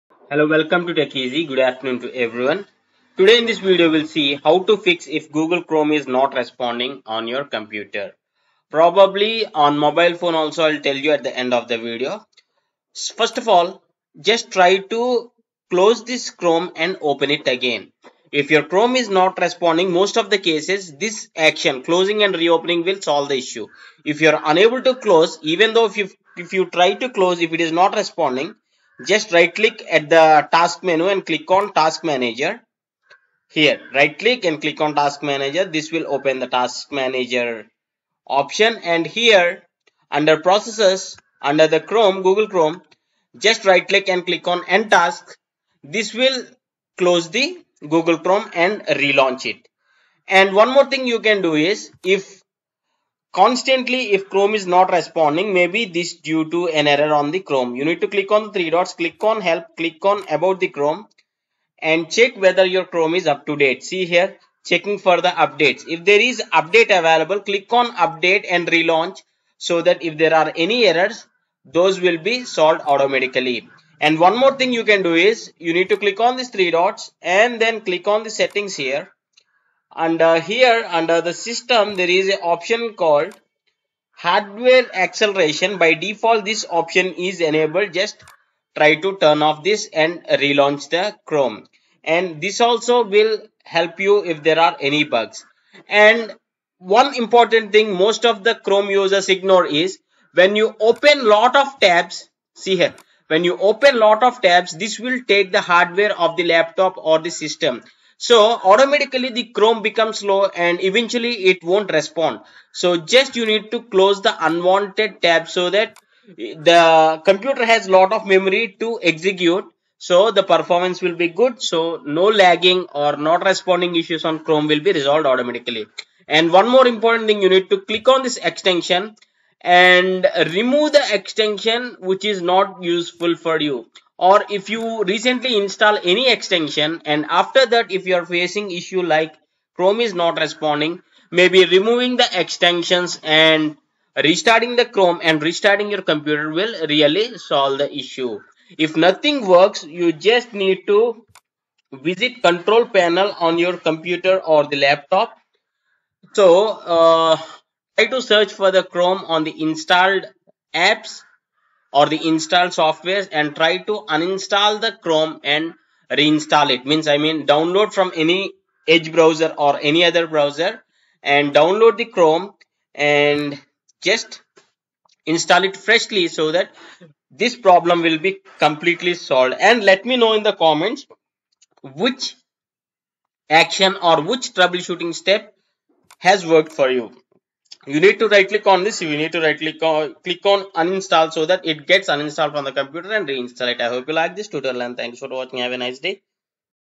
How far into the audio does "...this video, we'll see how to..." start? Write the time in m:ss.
0:03.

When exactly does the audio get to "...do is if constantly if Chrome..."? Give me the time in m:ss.
0:51.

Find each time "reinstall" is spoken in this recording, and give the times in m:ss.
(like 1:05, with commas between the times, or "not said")
2:46, 3:13.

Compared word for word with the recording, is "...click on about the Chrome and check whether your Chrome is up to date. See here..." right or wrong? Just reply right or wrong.
right.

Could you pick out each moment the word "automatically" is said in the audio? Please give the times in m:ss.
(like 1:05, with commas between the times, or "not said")
1:12, 1:48, 2:05.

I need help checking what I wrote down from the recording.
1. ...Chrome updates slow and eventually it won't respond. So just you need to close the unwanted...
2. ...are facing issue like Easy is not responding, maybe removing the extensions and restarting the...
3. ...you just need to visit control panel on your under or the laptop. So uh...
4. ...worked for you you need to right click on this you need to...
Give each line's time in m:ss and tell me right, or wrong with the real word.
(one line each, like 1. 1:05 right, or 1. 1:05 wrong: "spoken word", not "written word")
1. 1:49 wrong: "becomes", not "updates"
2. 2:18 wrong: "Chrome", not "Easy"
3. 2:29 wrong: "computer", not "under"
4. 3:06 right.